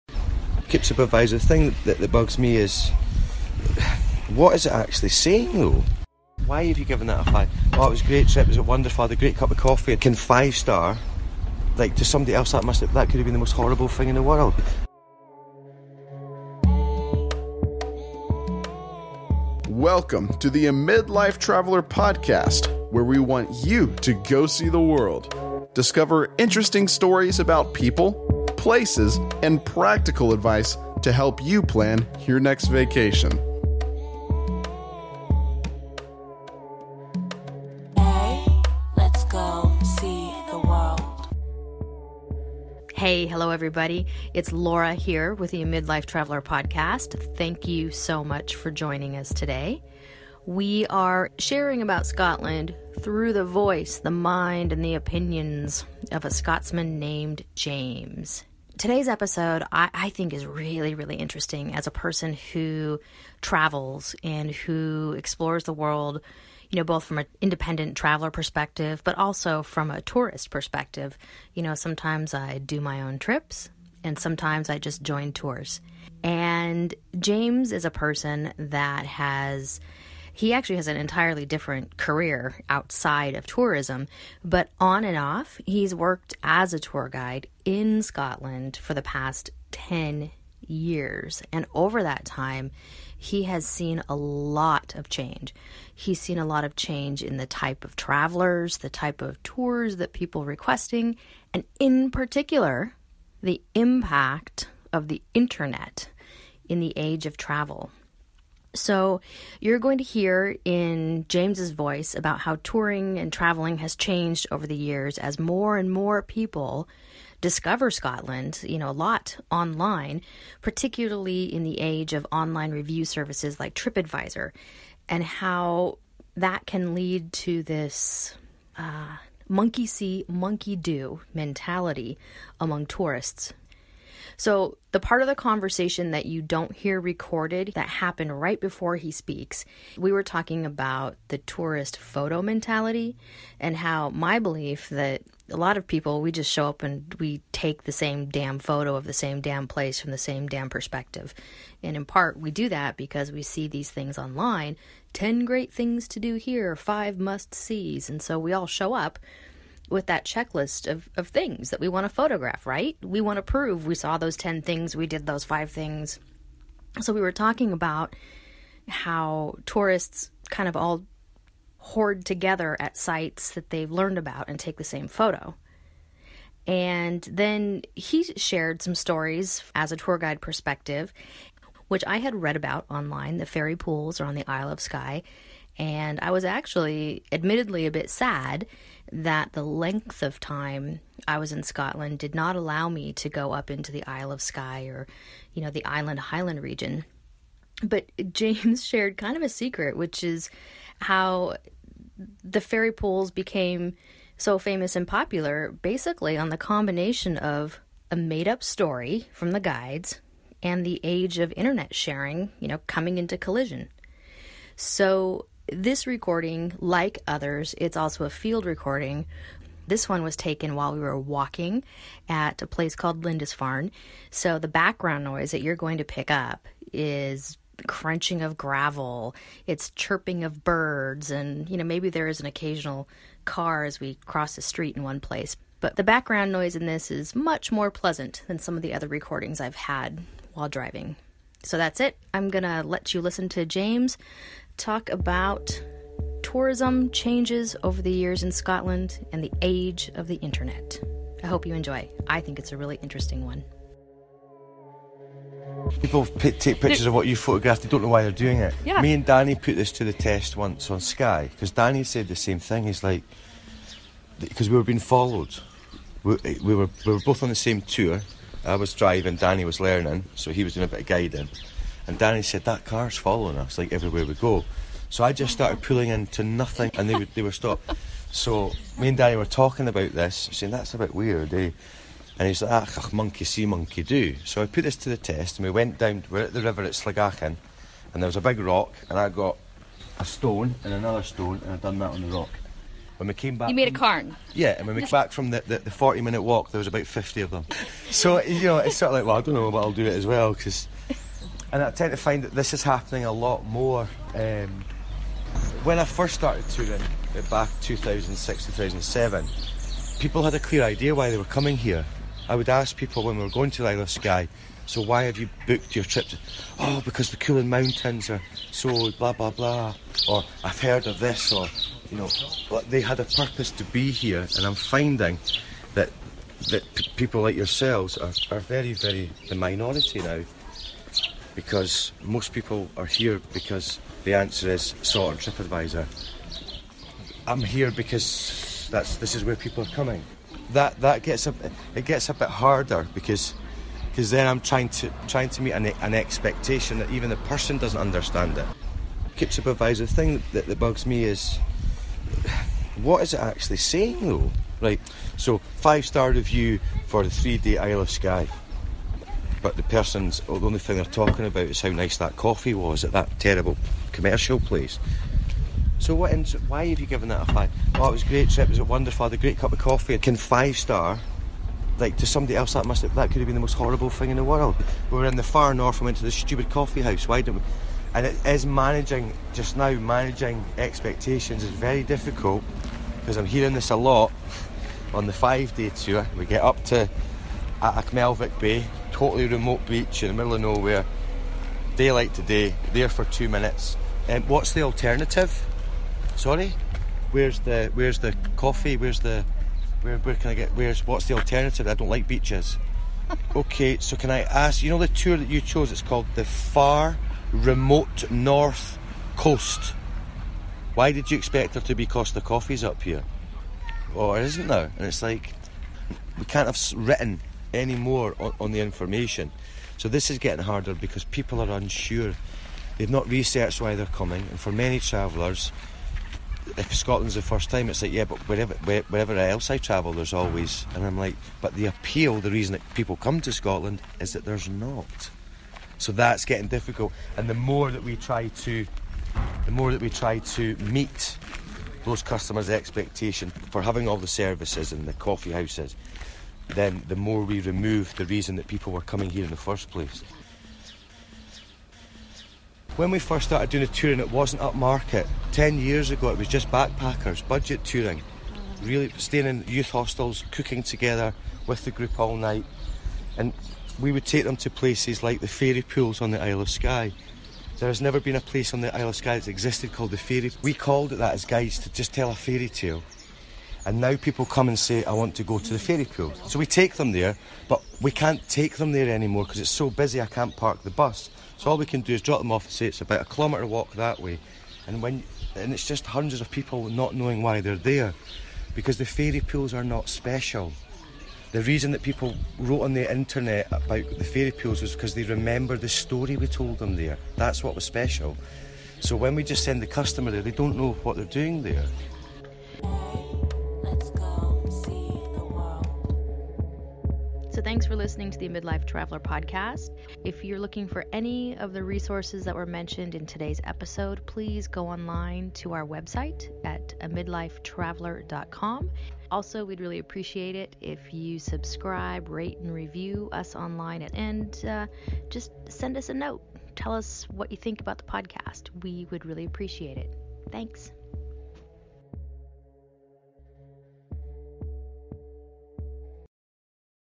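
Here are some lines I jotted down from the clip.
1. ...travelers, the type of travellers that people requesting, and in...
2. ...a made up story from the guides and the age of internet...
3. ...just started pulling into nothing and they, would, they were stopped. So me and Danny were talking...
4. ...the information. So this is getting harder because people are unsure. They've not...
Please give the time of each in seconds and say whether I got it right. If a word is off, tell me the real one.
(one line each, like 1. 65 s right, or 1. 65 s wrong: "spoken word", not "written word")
1. 97 s wrong: "tours", not "travellers"
2. 208 s right
3. 275 s right
4. 418 s right.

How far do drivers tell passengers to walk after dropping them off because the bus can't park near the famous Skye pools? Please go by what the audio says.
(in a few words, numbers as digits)
1 kilometre.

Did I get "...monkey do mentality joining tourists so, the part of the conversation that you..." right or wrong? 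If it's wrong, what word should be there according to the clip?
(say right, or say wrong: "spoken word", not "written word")
wrong: "among", not "joining".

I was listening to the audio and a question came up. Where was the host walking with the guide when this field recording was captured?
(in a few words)
Lindisfarne.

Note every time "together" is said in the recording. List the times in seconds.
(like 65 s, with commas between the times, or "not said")
172 s, 460 s.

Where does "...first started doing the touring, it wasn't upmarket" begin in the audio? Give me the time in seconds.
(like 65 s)
453 s.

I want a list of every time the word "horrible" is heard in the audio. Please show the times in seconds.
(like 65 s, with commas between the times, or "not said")
13 s, 373 s.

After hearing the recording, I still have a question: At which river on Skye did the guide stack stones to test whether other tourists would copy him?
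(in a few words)
Sligachan.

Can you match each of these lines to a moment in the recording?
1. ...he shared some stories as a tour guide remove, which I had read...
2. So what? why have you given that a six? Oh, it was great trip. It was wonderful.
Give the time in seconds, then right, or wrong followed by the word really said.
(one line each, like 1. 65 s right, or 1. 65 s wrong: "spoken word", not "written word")
1. 177 s wrong: "perspective", not "remove"
2. 365 s wrong: "five", not "six".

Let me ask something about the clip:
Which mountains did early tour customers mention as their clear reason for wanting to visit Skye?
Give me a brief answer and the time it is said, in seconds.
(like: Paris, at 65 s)
Cuillin Mountains, at 317 s.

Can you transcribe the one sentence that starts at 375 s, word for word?
We were in the far north We went to the stupid coffee house.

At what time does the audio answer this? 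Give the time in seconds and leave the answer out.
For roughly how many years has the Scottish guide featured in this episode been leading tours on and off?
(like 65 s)
89 s.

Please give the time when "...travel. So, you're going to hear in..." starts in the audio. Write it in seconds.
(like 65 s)
107 s.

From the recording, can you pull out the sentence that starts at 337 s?
I'm here because that's this is where people are coming.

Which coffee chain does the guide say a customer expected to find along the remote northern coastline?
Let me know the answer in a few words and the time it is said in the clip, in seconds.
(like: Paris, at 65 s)
Costa, at 412 s.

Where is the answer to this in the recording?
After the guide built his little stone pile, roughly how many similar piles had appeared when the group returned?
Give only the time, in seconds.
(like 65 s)
297 s.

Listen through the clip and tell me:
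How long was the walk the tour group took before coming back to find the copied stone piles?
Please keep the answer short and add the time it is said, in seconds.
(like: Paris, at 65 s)
40 minutes, at 295 s.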